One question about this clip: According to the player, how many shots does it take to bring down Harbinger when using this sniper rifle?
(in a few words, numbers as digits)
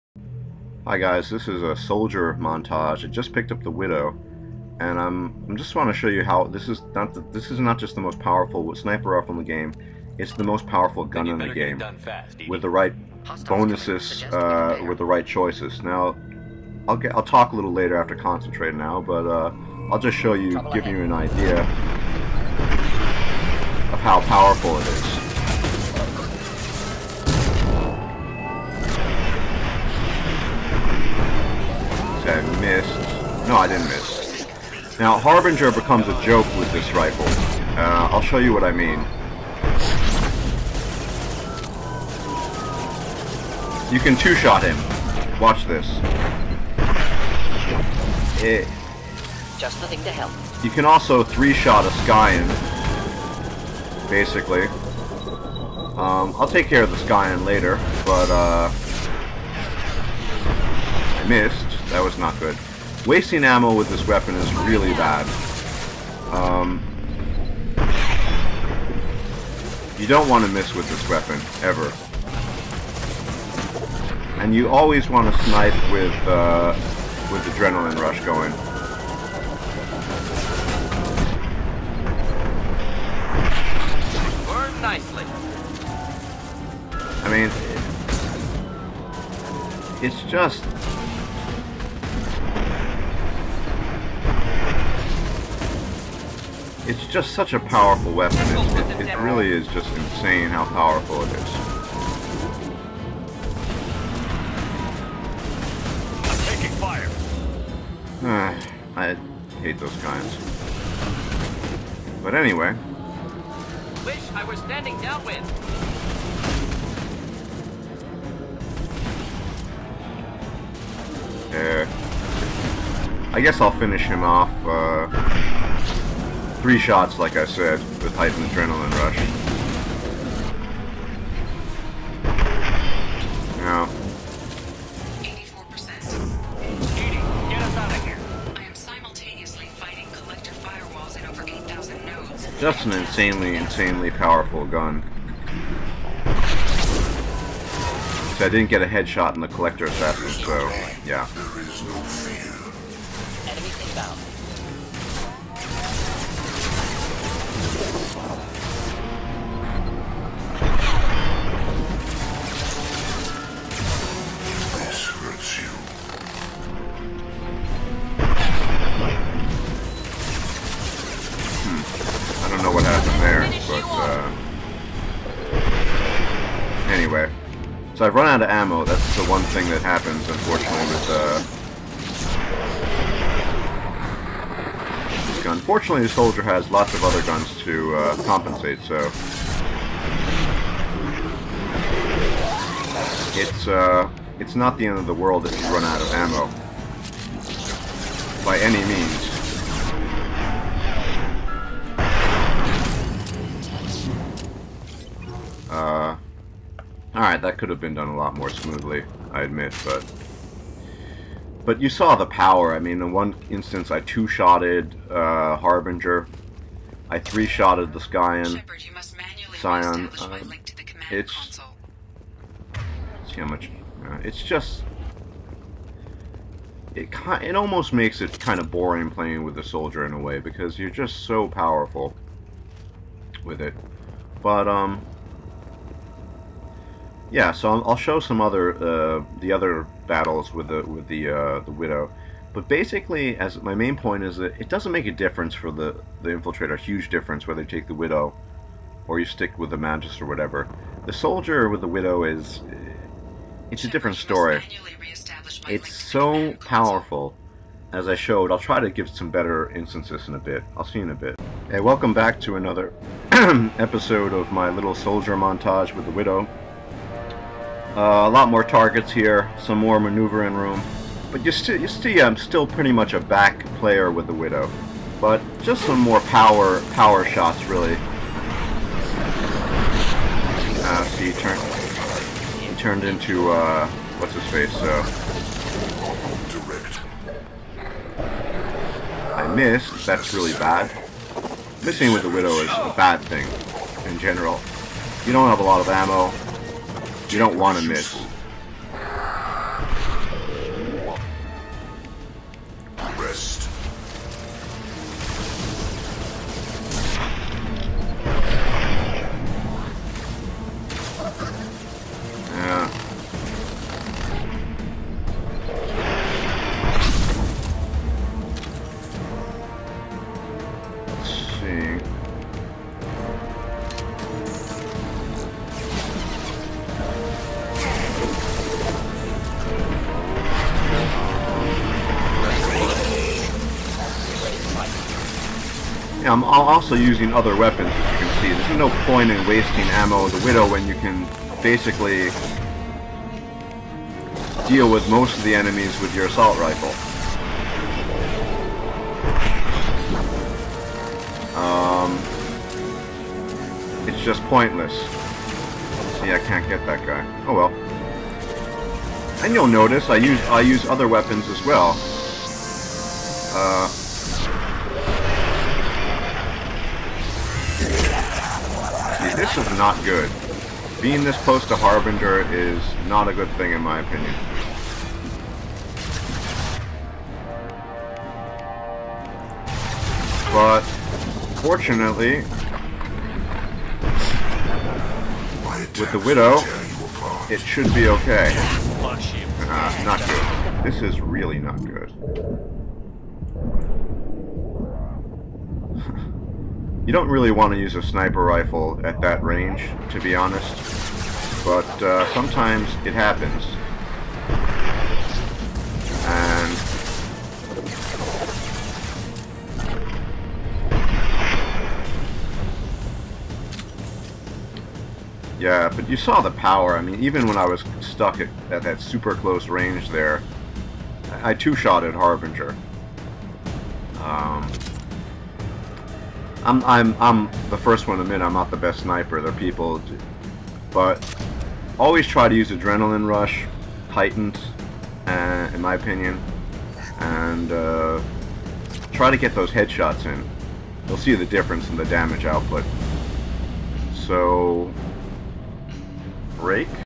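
2.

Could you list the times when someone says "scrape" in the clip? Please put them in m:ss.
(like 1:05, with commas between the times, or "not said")
not said.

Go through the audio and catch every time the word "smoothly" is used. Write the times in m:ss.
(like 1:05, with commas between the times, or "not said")
3:28.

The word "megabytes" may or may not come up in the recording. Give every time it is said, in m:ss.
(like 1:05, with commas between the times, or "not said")
not said.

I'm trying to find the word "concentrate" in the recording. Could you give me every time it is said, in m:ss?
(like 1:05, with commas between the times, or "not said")
0:18.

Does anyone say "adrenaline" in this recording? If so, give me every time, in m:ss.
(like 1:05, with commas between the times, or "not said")
1:17, 2:08, 7:12.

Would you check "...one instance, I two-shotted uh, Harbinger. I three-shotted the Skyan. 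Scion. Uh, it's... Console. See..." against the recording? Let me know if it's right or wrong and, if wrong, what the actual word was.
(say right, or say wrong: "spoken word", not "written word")
right.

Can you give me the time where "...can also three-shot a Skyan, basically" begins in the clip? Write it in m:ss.
0:50.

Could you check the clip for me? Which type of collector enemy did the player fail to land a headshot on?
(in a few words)
Collector assassin.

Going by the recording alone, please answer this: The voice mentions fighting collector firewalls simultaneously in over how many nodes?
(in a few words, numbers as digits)
8,000.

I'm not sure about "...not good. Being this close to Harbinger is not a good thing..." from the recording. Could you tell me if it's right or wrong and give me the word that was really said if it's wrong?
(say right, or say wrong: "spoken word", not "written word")
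right.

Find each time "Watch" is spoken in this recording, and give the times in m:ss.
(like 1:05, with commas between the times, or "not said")
0:45.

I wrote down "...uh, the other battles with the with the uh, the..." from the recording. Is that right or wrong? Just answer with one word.
right.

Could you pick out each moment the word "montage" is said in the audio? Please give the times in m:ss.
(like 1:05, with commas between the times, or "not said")
0:02, 4:25.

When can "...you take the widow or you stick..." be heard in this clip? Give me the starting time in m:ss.
4:07.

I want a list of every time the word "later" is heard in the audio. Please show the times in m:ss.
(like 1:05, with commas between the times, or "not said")
0:17, 0:57.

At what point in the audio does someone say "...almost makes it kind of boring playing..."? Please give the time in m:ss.
3:47.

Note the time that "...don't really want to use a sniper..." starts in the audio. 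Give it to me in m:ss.
6:37.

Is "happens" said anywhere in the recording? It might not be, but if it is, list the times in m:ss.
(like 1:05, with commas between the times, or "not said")
2:59, 6:43.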